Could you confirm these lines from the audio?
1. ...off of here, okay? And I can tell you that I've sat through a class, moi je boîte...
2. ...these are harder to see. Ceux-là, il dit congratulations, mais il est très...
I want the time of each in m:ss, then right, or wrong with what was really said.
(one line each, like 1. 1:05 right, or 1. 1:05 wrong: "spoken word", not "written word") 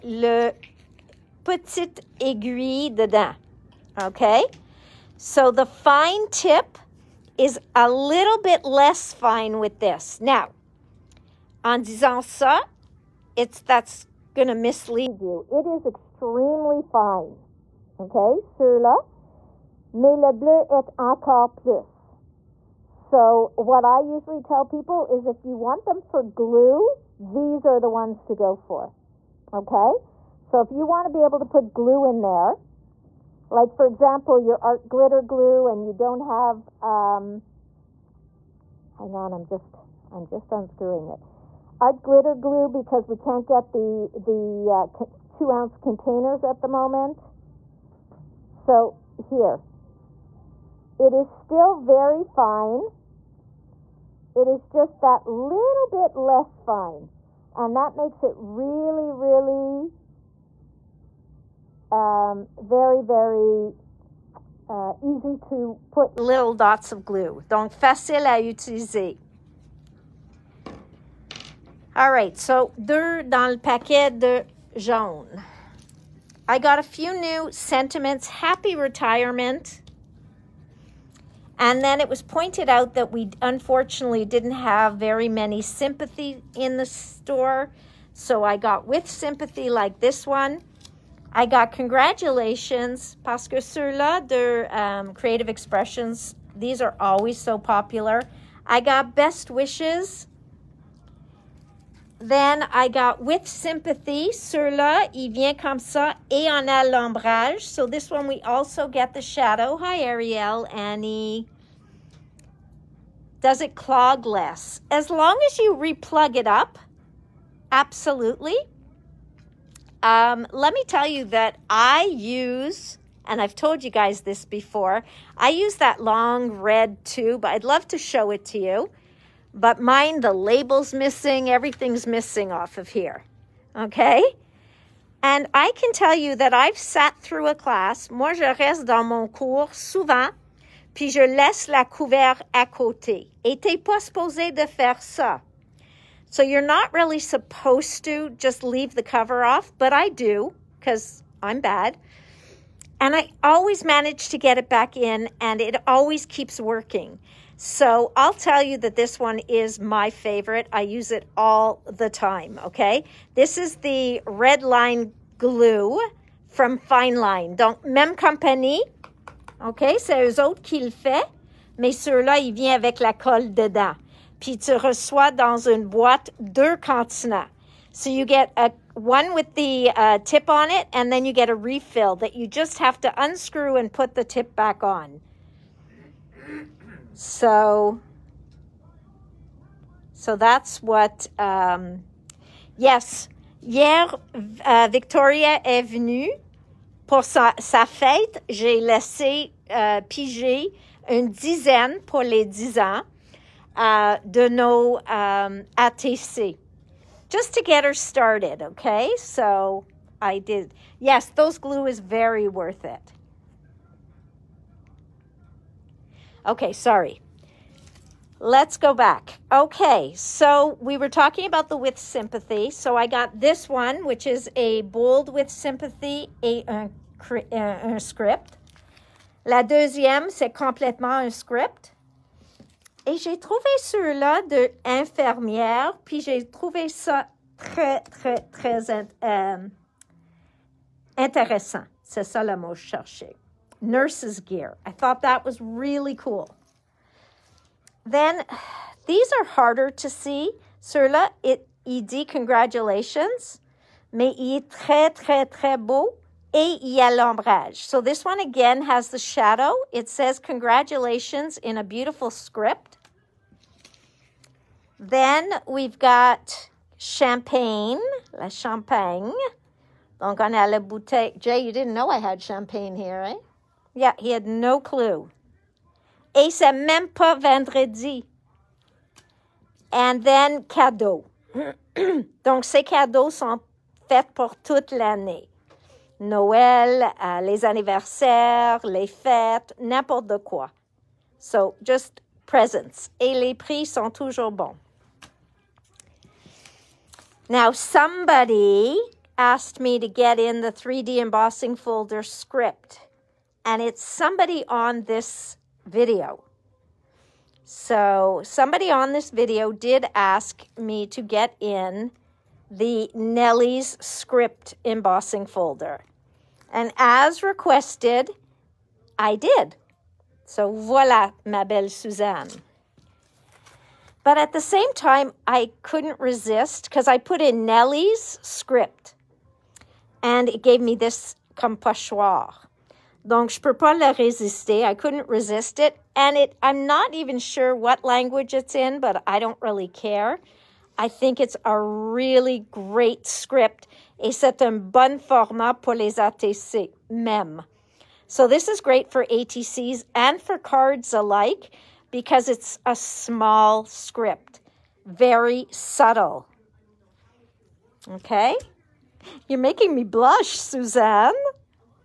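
1. 2:12 wrong: "reste", not "boîte"
2. 4:09 right.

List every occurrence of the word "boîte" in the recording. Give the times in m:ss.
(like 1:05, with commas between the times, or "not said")
2:55.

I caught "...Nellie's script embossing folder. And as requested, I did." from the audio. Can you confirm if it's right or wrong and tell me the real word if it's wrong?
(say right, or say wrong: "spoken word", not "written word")
right.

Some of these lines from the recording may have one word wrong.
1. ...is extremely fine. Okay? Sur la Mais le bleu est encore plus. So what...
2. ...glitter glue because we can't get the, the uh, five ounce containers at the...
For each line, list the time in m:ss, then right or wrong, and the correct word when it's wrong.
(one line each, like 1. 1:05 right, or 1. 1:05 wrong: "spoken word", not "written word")
1. 0:15 right
2. 0:42 wrong: "two", not "five".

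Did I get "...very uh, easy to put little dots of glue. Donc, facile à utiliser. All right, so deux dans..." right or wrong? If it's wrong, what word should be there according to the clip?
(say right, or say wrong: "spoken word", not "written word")
right.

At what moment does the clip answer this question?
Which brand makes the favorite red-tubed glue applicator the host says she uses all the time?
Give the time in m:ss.
2:46.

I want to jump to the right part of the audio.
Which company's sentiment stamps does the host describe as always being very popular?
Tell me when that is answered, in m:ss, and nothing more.
1:35.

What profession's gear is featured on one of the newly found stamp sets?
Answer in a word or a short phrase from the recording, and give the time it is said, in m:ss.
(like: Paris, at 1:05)
Nurse, at 4:03.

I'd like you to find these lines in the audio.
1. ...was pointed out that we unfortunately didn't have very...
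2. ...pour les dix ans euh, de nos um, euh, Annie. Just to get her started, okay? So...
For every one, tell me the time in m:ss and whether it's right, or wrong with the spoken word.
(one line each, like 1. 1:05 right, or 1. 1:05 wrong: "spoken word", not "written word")
1. 1:22 right
2. 3:22 wrong: "ATC", not "Annie".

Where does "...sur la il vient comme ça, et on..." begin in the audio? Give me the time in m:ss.
1:44.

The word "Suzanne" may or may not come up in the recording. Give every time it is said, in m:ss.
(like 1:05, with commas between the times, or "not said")
5:21, 6:00.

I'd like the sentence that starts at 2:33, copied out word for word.
And I always manage to get it back in and it always keeps working.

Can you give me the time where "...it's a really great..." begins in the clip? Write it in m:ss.
5:41.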